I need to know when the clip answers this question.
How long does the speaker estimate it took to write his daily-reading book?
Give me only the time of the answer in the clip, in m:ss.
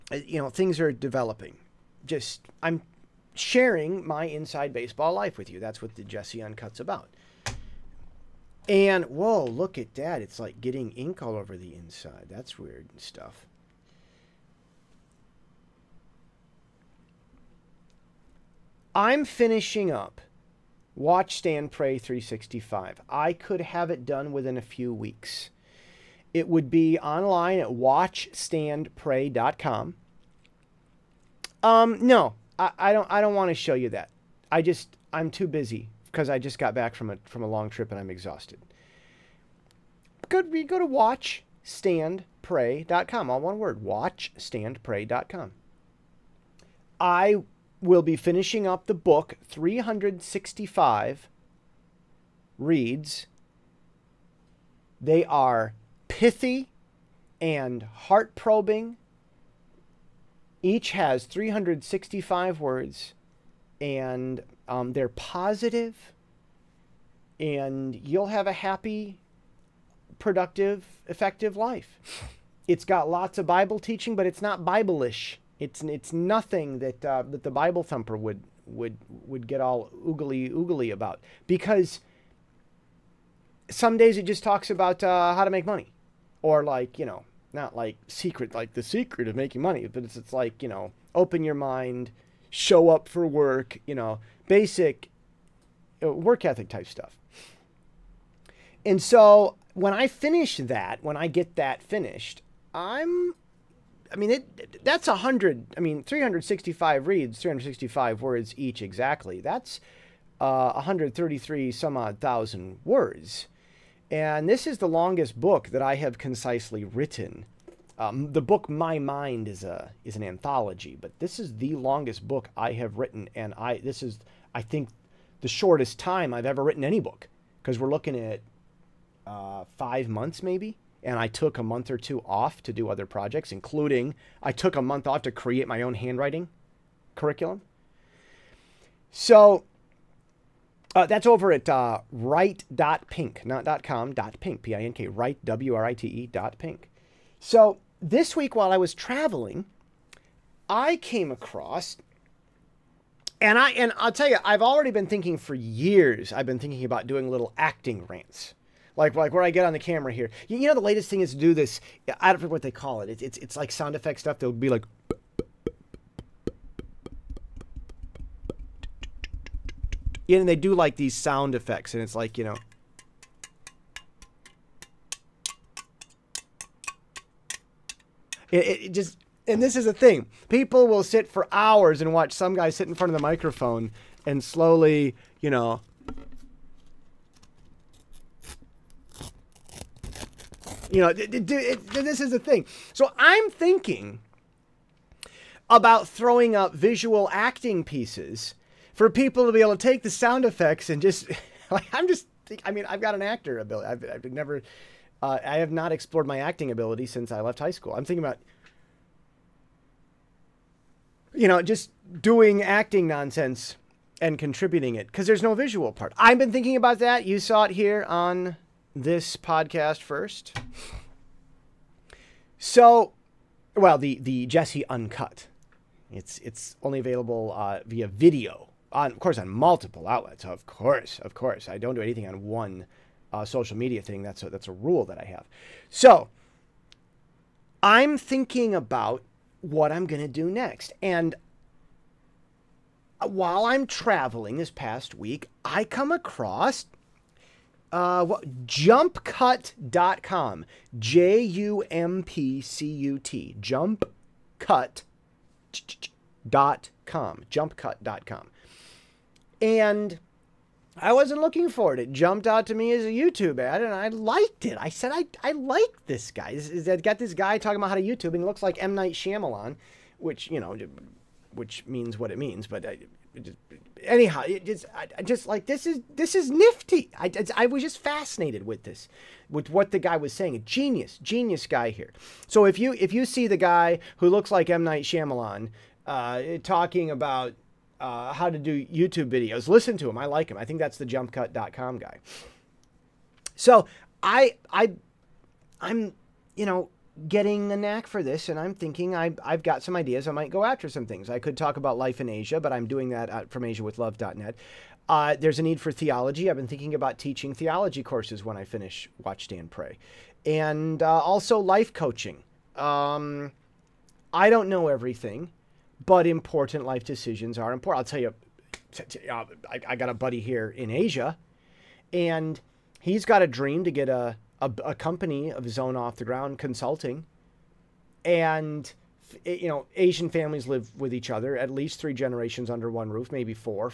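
2:09.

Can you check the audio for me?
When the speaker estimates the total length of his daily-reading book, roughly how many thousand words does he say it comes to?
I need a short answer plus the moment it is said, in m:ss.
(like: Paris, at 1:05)
133 thousand, at 1:50.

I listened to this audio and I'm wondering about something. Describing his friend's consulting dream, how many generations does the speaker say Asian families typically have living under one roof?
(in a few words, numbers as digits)
3 generations.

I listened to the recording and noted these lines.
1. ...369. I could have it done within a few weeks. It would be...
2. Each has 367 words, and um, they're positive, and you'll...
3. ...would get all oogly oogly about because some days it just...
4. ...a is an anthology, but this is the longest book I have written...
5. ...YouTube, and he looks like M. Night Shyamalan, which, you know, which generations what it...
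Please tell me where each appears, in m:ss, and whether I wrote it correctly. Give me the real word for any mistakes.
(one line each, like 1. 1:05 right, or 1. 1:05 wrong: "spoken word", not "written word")
1. 0:21 wrong: "365", not "369"
2. 1:00 wrong: "365", not "367"
3. 1:19 right
4. 1:59 right
5. 4:28 wrong: "means", not "generations".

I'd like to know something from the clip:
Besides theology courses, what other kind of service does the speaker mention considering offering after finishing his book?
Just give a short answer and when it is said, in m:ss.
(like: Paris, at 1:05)
life coaching, at 5:11.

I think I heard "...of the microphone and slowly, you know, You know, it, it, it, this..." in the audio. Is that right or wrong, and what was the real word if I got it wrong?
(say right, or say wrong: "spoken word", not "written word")
right.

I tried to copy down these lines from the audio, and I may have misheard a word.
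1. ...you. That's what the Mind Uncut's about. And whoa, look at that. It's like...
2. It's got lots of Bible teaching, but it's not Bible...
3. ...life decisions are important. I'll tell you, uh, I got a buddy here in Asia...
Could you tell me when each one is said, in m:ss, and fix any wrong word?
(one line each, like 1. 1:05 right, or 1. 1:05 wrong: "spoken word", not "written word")
1. 0:05 wrong: "Jesse", not "Mind"
2. 1:12 right
3. 5:16 right.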